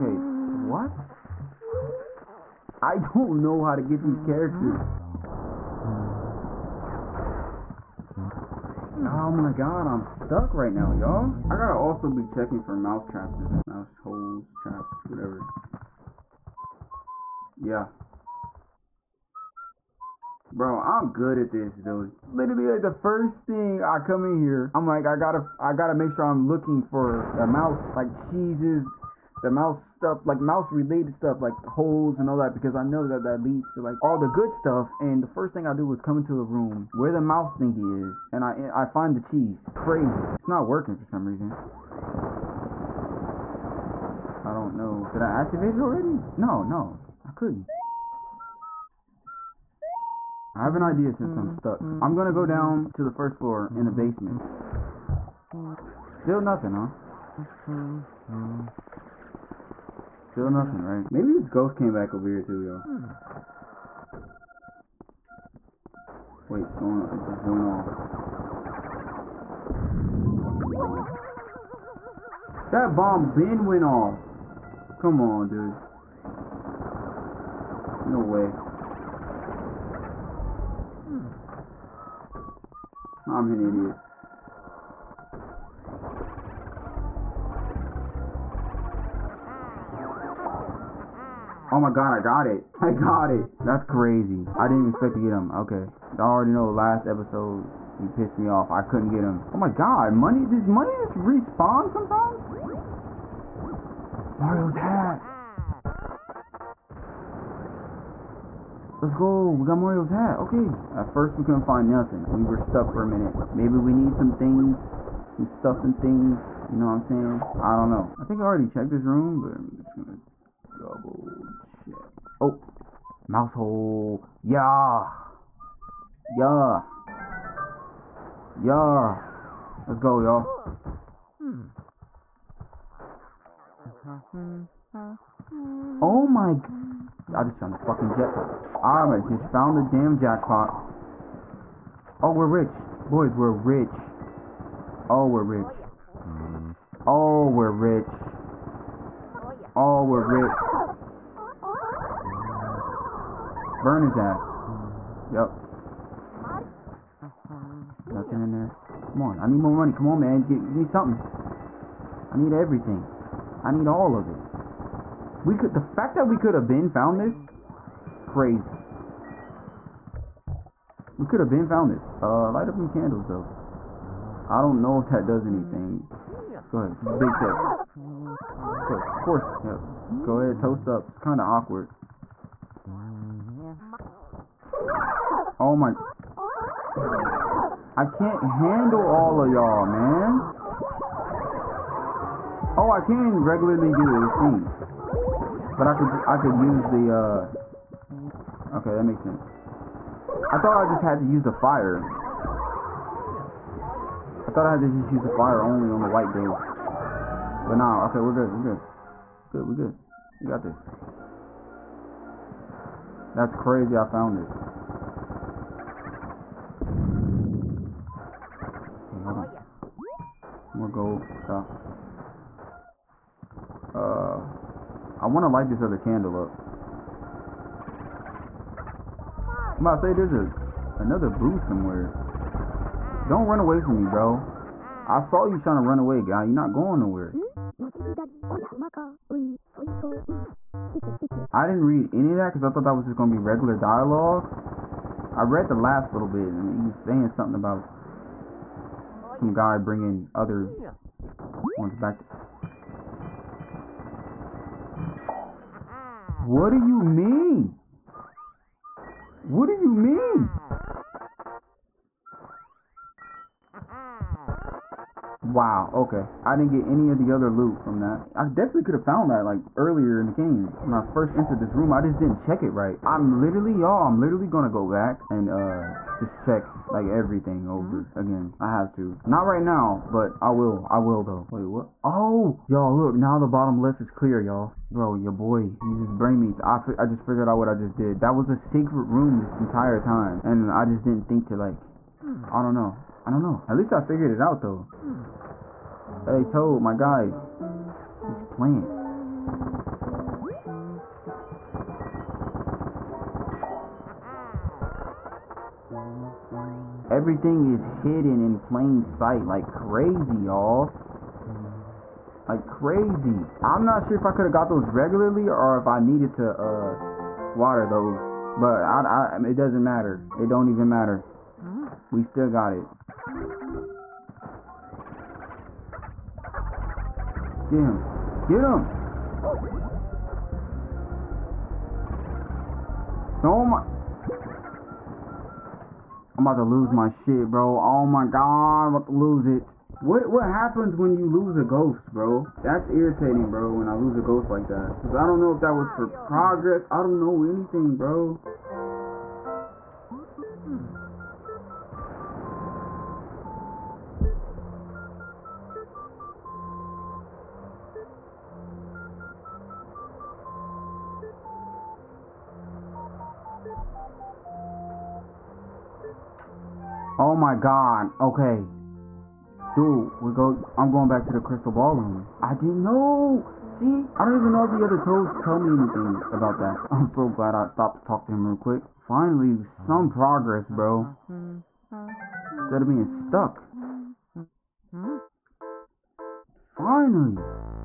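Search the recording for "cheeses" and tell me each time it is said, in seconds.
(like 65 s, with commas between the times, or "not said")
28 s, 39 s.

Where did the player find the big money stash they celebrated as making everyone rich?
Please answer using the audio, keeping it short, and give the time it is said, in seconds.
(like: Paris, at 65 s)
Mouse hole, at 123 s.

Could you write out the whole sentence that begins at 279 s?
Not right now, but I will.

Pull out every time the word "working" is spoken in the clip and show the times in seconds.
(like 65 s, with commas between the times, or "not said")
40 s.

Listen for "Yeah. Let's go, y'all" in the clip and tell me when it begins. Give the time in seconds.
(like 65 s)
128 s.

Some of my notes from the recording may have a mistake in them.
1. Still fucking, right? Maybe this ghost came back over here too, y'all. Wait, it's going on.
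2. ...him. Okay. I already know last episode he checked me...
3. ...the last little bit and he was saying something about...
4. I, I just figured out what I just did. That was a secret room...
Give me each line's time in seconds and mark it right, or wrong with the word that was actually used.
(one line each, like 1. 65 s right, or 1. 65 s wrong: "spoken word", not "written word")
1. 60 s wrong: "nothing", not "fucking"
2. 95 s wrong: "pissed", not "checked"
3. 245 s right
4. 286 s right.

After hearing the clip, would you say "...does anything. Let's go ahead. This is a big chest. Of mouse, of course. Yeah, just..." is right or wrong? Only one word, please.
wrong.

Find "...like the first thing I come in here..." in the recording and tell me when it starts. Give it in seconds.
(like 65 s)
22 s.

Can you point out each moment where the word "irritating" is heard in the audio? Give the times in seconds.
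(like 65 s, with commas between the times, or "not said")
342 s.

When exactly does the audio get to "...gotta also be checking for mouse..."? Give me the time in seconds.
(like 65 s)
11 s.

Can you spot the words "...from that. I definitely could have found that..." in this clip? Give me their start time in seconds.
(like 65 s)
267 s.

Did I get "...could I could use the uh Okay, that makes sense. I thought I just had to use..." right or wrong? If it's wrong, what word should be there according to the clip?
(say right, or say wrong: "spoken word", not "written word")
right.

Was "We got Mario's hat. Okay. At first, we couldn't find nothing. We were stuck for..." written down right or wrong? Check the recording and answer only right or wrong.
right.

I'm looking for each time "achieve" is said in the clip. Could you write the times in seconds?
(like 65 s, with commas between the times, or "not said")
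not said.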